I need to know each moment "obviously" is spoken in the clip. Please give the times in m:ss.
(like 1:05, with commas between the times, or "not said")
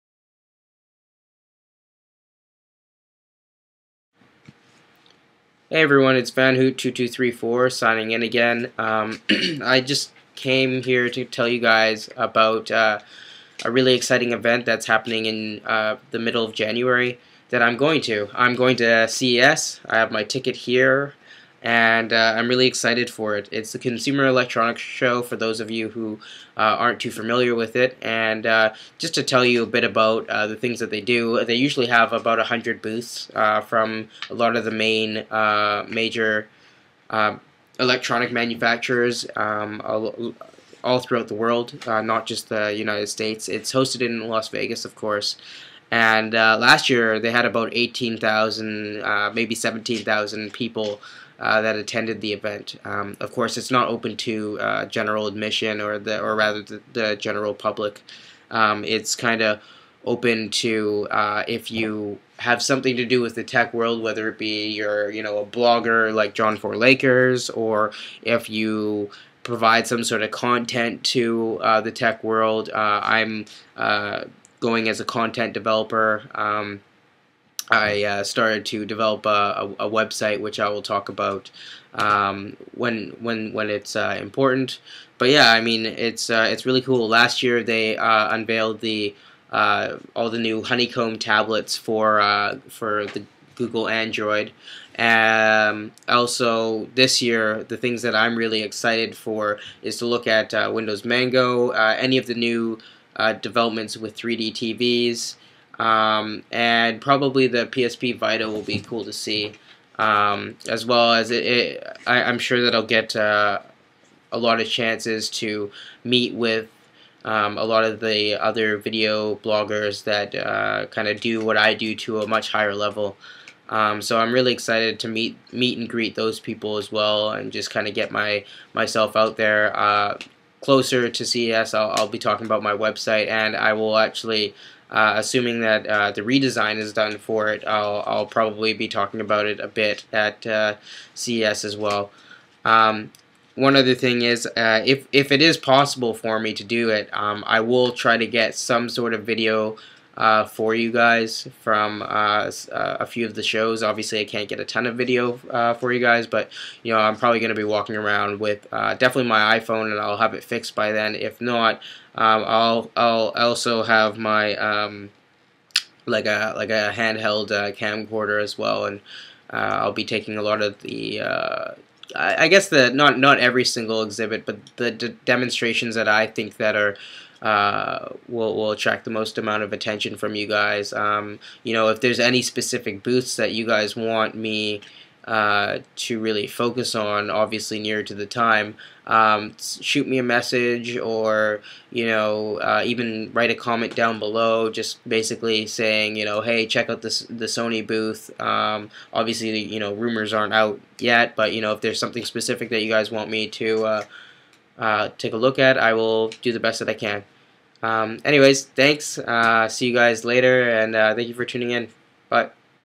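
2:33, 3:07, 3:19.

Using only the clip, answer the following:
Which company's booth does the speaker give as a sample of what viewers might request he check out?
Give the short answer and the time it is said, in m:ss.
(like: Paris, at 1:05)
Sony, at 3:17.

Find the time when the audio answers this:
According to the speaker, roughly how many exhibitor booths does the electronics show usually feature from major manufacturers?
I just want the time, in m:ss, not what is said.
0:32.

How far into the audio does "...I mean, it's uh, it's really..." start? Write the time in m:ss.
1:25.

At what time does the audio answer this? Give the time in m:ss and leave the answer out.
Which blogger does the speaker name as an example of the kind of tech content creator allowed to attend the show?
1:06.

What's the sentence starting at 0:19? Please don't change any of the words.
I have my ticket here and uh, I'm really excited for it.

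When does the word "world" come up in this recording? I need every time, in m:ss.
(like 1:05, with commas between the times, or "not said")
0:41, 1:03, 1:12.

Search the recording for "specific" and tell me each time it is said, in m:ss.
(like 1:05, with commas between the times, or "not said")
3:02, 3:22.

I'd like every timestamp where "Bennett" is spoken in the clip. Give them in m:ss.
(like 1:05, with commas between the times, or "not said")
not said.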